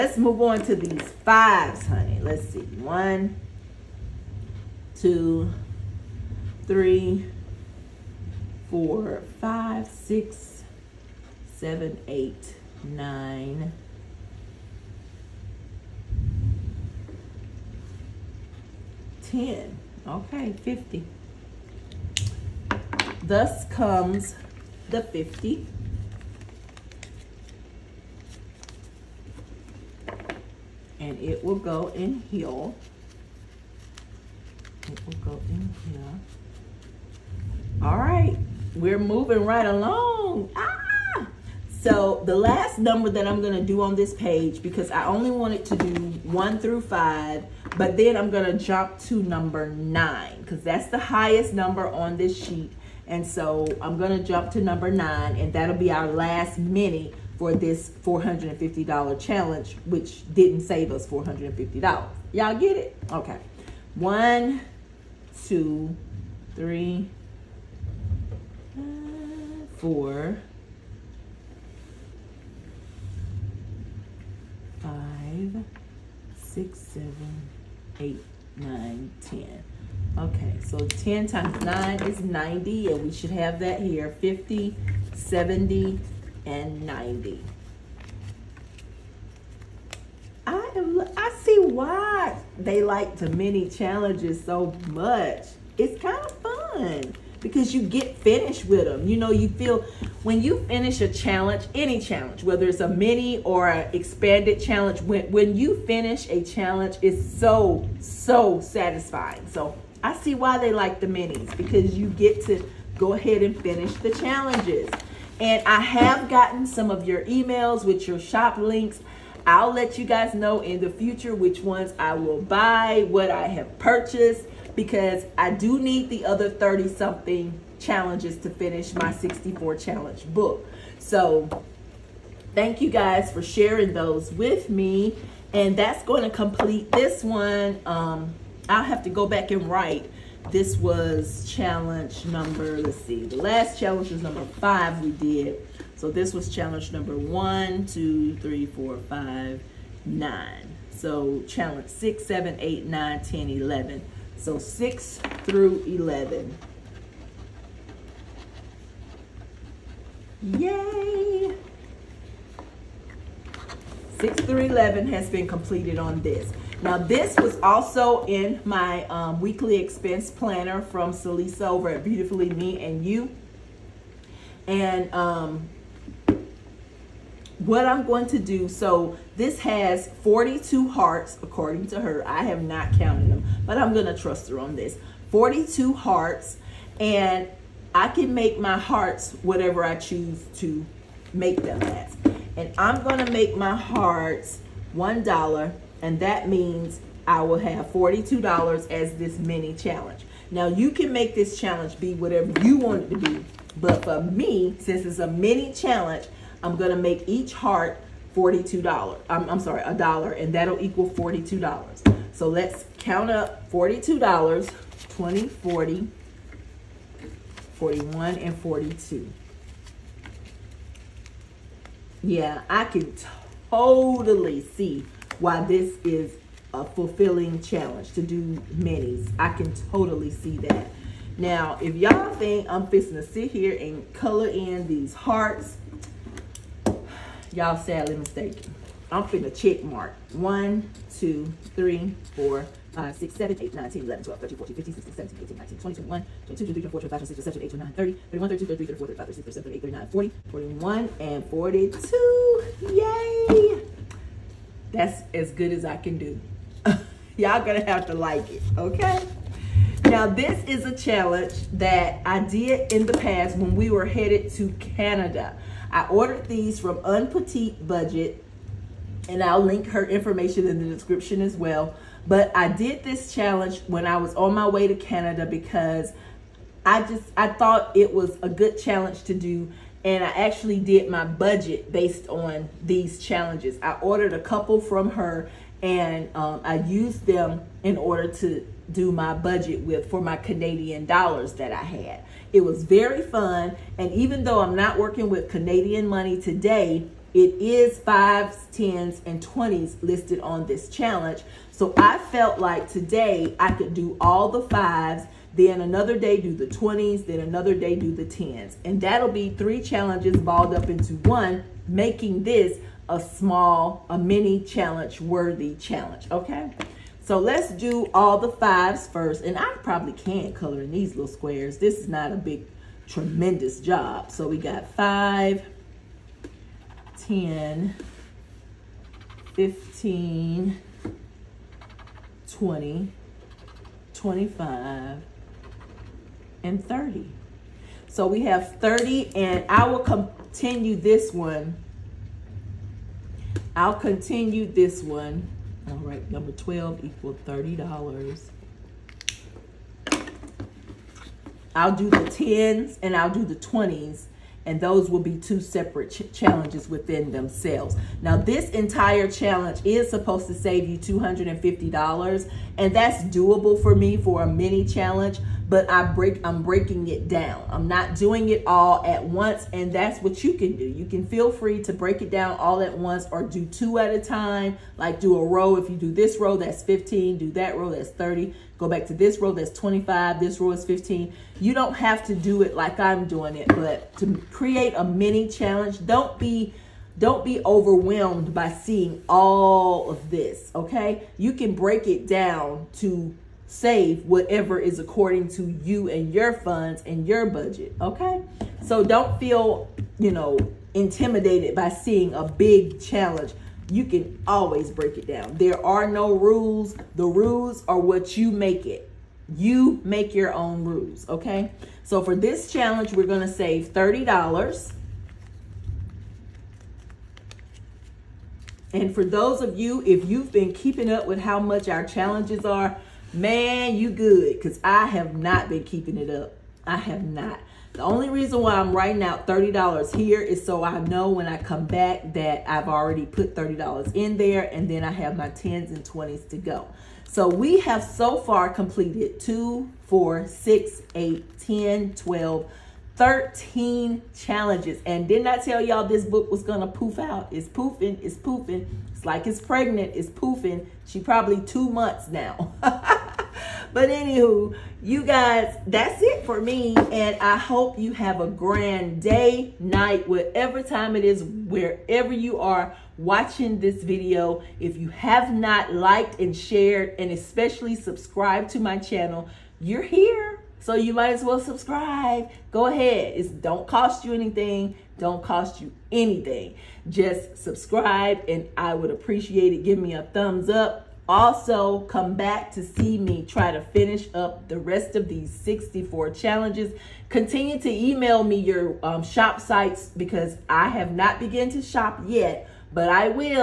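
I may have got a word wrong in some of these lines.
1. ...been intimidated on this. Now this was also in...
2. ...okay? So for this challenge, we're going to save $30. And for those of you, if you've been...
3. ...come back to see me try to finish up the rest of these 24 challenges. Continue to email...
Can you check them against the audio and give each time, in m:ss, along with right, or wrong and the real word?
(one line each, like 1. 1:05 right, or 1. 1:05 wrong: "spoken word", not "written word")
1. 2:45 wrong: "completed", not "intimidated"
2. 6:51 right
3. 8:02 wrong: "64", not "24".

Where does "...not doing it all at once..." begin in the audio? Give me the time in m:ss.
6:07.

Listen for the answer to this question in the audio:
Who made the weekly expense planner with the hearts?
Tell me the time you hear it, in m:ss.
2:52.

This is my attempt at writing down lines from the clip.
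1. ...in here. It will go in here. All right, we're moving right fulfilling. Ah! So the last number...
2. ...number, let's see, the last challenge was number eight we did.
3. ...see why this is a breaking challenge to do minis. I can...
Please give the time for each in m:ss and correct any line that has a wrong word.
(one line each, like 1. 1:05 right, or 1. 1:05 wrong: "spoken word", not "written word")
1. 0:31 wrong: "along", not "fulfilling"
2. 2:22 wrong: "five", not "eight"
3. 3:44 wrong: "fulfilling", not "breaking".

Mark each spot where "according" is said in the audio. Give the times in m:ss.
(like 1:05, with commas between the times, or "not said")
3:01, 6:34.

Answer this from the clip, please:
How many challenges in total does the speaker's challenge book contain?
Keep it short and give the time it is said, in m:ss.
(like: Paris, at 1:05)
64, at 2:09.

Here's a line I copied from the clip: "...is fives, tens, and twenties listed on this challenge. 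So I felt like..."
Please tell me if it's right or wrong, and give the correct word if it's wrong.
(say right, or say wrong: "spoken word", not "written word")
right.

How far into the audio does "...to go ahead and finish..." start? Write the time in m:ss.
1:52.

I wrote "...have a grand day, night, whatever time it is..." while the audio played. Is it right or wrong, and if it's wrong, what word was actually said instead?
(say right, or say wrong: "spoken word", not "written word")
right.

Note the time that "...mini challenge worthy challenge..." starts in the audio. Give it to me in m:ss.
5:14.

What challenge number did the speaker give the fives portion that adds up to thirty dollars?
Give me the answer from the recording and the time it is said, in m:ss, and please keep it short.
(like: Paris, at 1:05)
12, at 5:46.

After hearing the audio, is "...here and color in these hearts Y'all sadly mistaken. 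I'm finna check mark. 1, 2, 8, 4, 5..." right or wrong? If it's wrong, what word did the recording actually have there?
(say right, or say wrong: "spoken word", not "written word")
wrong: "3", not "8".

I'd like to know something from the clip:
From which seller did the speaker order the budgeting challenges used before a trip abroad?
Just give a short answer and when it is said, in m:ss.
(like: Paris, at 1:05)
Un Petit Budget, at 4:27.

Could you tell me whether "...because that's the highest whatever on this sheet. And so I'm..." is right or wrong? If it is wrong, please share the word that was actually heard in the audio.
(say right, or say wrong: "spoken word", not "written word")
wrong: "number", not "whatever".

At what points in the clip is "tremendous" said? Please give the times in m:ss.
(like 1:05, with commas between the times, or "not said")
5:23.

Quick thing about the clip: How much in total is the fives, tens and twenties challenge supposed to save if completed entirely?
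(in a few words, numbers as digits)
$250.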